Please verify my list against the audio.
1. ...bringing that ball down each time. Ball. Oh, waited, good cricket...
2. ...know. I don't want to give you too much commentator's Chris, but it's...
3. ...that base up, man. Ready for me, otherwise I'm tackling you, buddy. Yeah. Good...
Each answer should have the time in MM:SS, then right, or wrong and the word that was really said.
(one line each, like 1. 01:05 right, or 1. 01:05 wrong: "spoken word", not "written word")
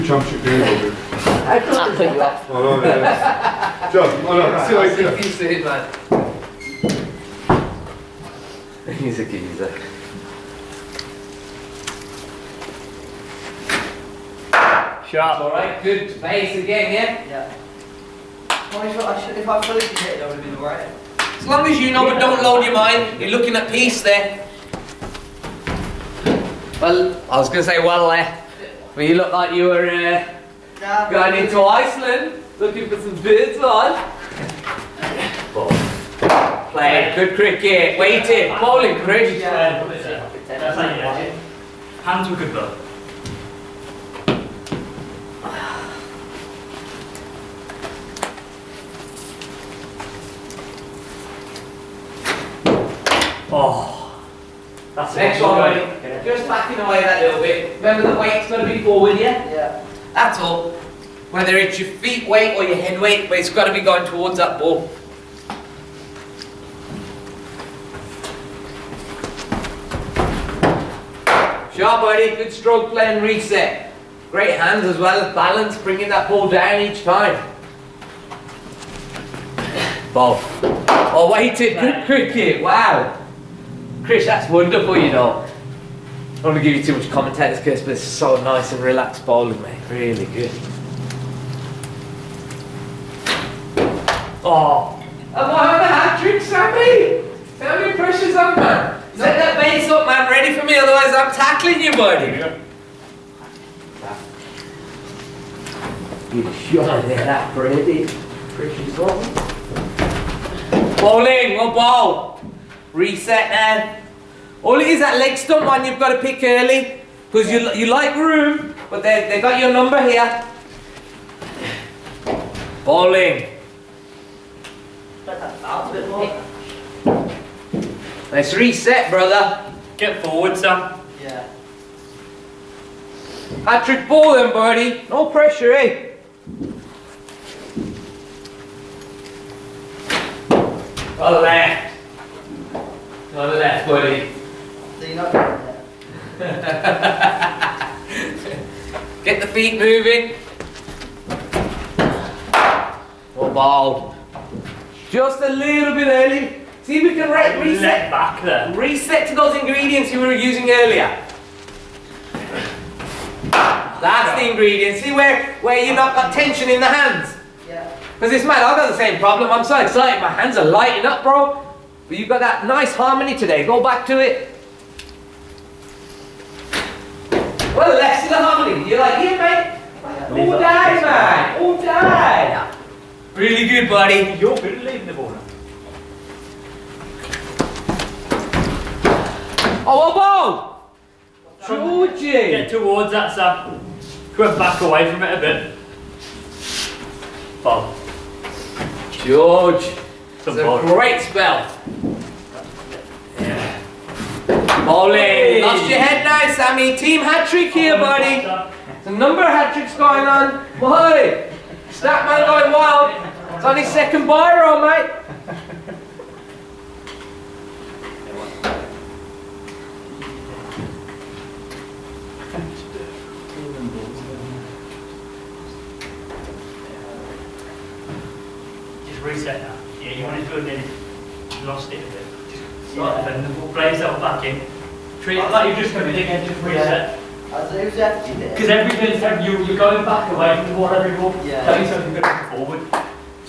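1. 01:15 right
2. 01:25 right
3. 01:39 right.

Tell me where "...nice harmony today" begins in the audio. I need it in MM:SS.
02:52.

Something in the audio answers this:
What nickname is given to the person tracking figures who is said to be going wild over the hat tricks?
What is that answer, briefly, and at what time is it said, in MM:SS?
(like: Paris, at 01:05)
Statman, at 03:31.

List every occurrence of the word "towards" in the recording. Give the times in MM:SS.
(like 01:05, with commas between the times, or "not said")
01:04, 03:12.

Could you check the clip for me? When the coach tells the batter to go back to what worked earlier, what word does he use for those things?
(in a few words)
Ingredients.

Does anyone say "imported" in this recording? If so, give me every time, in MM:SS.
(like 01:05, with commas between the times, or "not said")
not said.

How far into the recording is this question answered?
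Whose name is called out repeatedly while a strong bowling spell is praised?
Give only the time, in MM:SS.
03:19.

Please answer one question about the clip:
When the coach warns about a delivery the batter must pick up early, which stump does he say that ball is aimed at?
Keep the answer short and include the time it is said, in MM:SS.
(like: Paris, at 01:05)
Leg stump, at 01:55.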